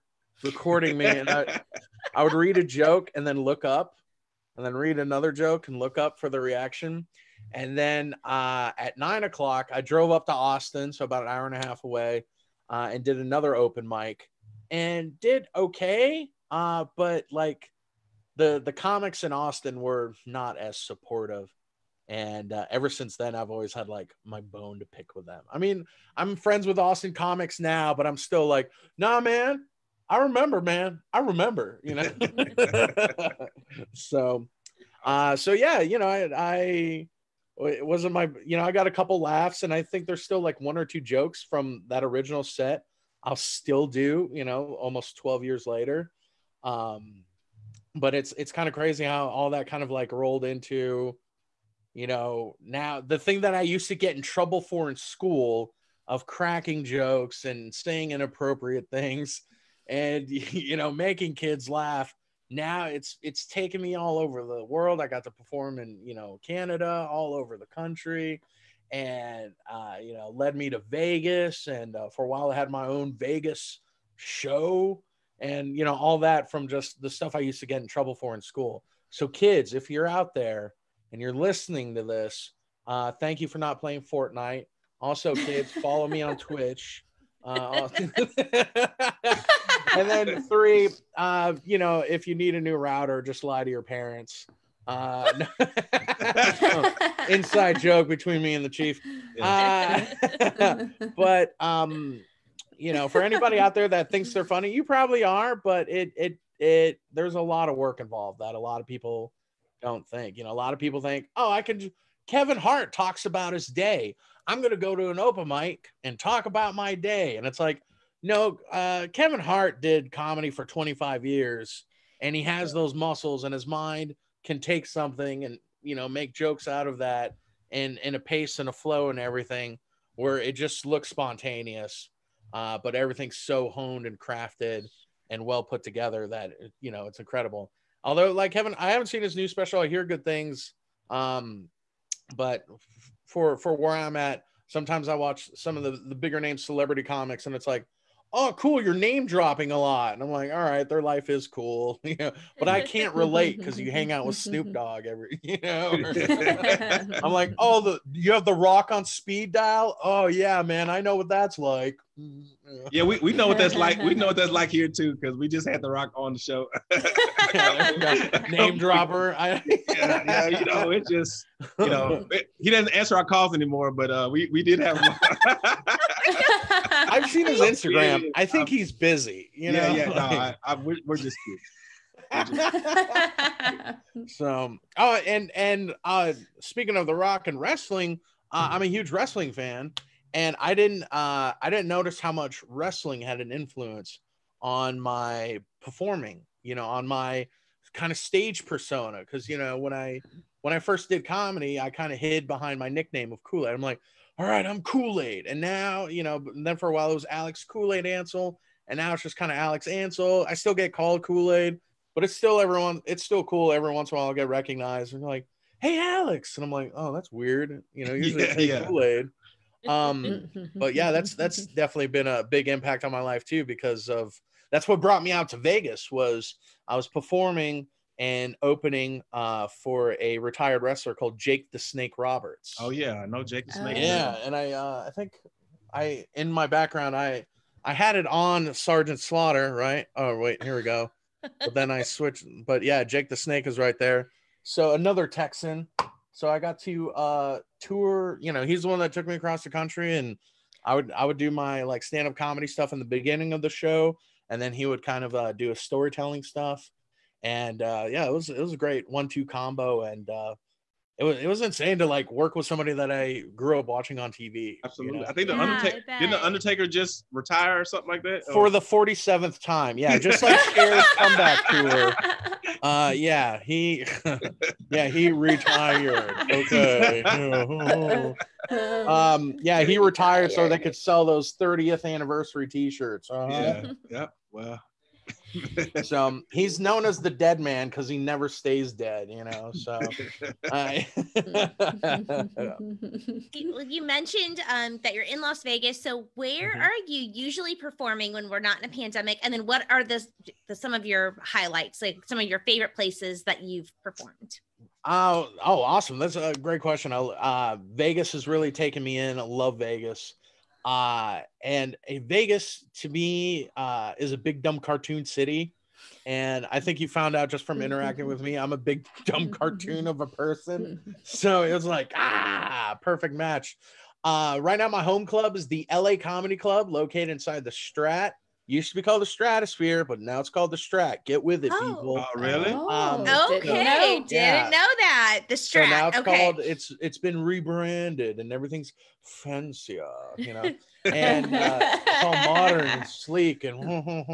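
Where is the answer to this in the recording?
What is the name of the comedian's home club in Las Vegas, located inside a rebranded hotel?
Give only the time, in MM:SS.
05:25.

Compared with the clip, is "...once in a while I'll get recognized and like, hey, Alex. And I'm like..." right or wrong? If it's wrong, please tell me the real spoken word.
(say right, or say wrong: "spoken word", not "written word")
right.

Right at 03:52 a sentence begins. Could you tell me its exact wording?
Oh yeah, I know Jake the Snake.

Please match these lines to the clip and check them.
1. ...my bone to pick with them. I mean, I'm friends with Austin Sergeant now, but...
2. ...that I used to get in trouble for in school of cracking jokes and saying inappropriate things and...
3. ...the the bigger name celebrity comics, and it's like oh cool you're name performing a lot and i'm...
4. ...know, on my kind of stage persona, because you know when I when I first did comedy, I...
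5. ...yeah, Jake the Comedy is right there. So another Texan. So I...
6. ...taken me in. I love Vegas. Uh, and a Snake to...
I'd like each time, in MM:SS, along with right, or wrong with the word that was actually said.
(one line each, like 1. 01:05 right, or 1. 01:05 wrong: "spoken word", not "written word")
1. 00:24 wrong: "Comics", not "Sergeant"
2. 00:53 right
3. 02:25 wrong: "dropping", not "performing"
4. 03:16 right
5. 04:02 wrong: "Snake", not "Comedy"
6. 05:08 wrong: "Vegas", not "Snake".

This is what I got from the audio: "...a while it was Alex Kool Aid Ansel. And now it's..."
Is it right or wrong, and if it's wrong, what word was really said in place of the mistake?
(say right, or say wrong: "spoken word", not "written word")
right.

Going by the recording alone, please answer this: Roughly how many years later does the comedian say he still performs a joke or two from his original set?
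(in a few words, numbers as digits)
12.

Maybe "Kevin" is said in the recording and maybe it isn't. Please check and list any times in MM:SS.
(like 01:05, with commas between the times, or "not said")
01:52, 01:59, 02:18.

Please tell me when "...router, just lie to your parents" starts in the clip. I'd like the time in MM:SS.
01:32.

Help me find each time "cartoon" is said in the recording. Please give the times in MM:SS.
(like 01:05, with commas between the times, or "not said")
05:14, 05:19.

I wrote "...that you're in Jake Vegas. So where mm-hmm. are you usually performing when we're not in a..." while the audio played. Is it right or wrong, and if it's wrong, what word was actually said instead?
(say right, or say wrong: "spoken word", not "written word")
wrong: "Las", not "Jake".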